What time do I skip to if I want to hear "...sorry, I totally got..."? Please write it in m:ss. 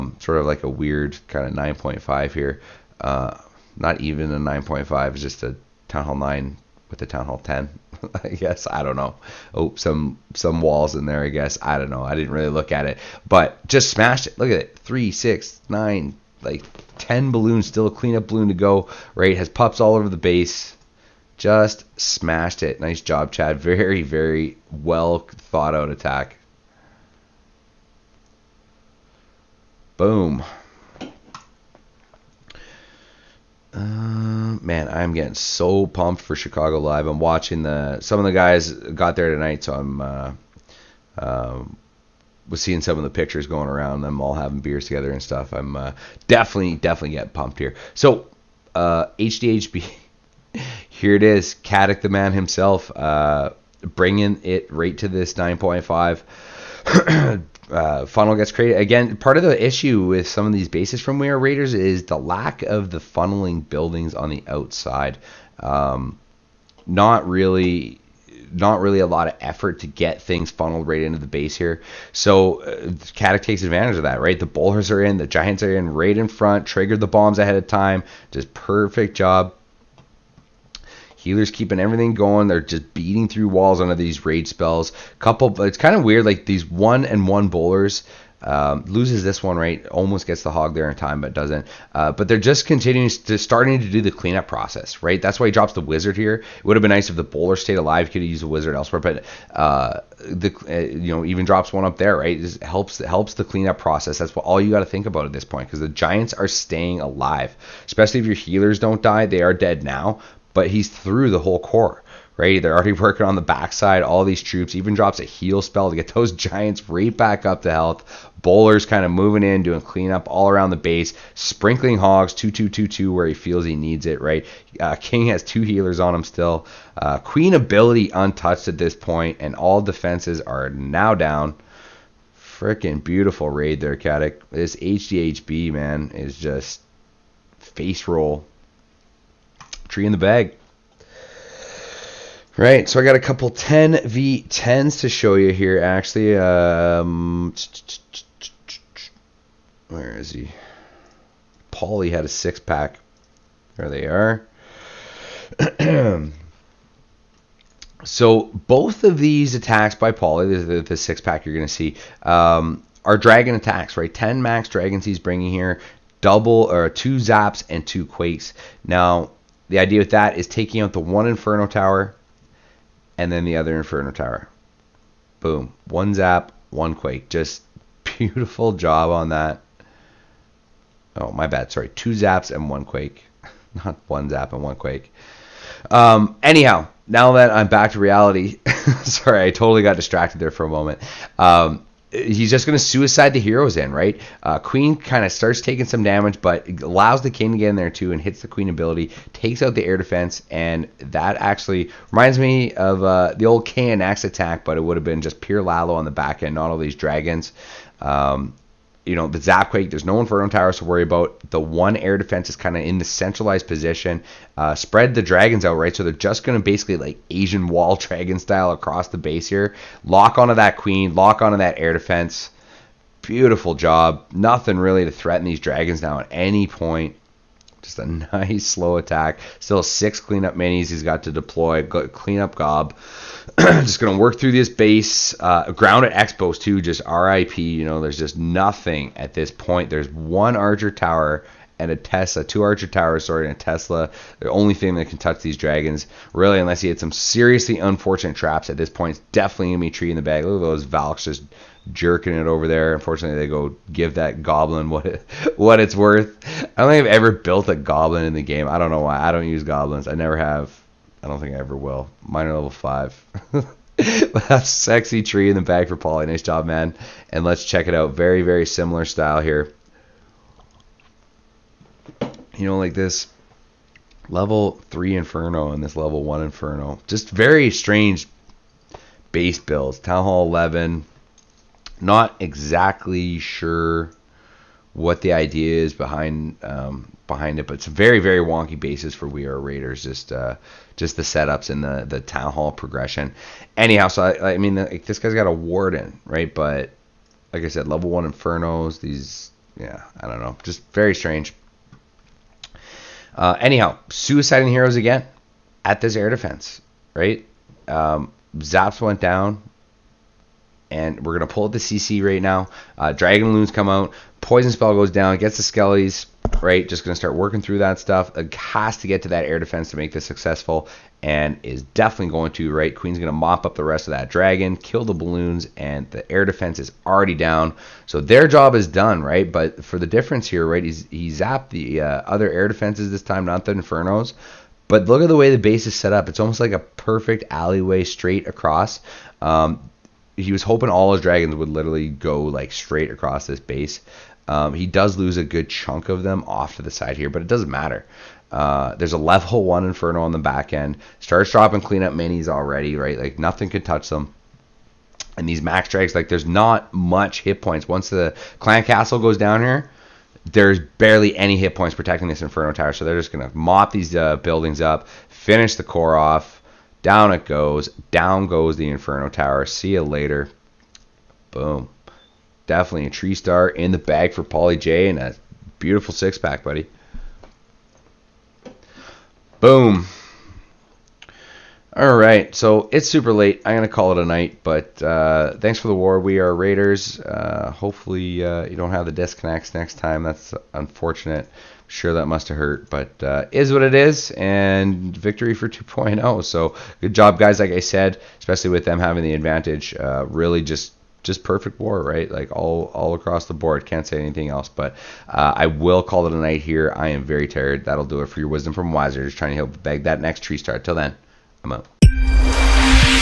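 3:09.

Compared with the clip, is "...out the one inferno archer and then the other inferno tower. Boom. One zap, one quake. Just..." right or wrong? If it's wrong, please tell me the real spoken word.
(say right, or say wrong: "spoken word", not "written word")
wrong: "tower", not "archer".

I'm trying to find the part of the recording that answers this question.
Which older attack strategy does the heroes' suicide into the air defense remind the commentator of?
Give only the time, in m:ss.
3:23.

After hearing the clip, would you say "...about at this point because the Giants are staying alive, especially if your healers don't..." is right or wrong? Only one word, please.
right.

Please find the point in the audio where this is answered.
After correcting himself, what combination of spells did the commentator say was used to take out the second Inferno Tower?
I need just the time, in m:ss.
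3:01.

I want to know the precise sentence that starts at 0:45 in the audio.
I'm uh, definitely definitely getting pumped here.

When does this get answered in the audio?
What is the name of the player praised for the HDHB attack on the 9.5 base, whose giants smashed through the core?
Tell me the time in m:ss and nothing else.
0:51.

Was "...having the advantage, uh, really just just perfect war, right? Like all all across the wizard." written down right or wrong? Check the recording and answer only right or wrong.
wrong.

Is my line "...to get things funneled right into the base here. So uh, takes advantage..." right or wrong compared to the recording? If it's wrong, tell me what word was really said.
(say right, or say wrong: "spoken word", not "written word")
right.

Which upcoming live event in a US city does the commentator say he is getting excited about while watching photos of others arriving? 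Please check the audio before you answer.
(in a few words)
Chicago Live.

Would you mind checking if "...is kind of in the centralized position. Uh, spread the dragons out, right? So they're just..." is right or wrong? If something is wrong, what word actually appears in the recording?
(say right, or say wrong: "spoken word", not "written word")
right.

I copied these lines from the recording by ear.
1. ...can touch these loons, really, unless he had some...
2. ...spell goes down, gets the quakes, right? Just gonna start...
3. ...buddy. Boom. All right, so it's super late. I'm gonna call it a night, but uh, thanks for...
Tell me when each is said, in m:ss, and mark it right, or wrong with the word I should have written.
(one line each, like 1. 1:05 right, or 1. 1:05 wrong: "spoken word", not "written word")
1. 4:05 wrong: "dragons", not "loons"
2. 5:14 wrong: "skellies", not "quakes"
3. 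6:16 right.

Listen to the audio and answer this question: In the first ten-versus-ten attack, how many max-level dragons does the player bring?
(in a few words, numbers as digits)
10.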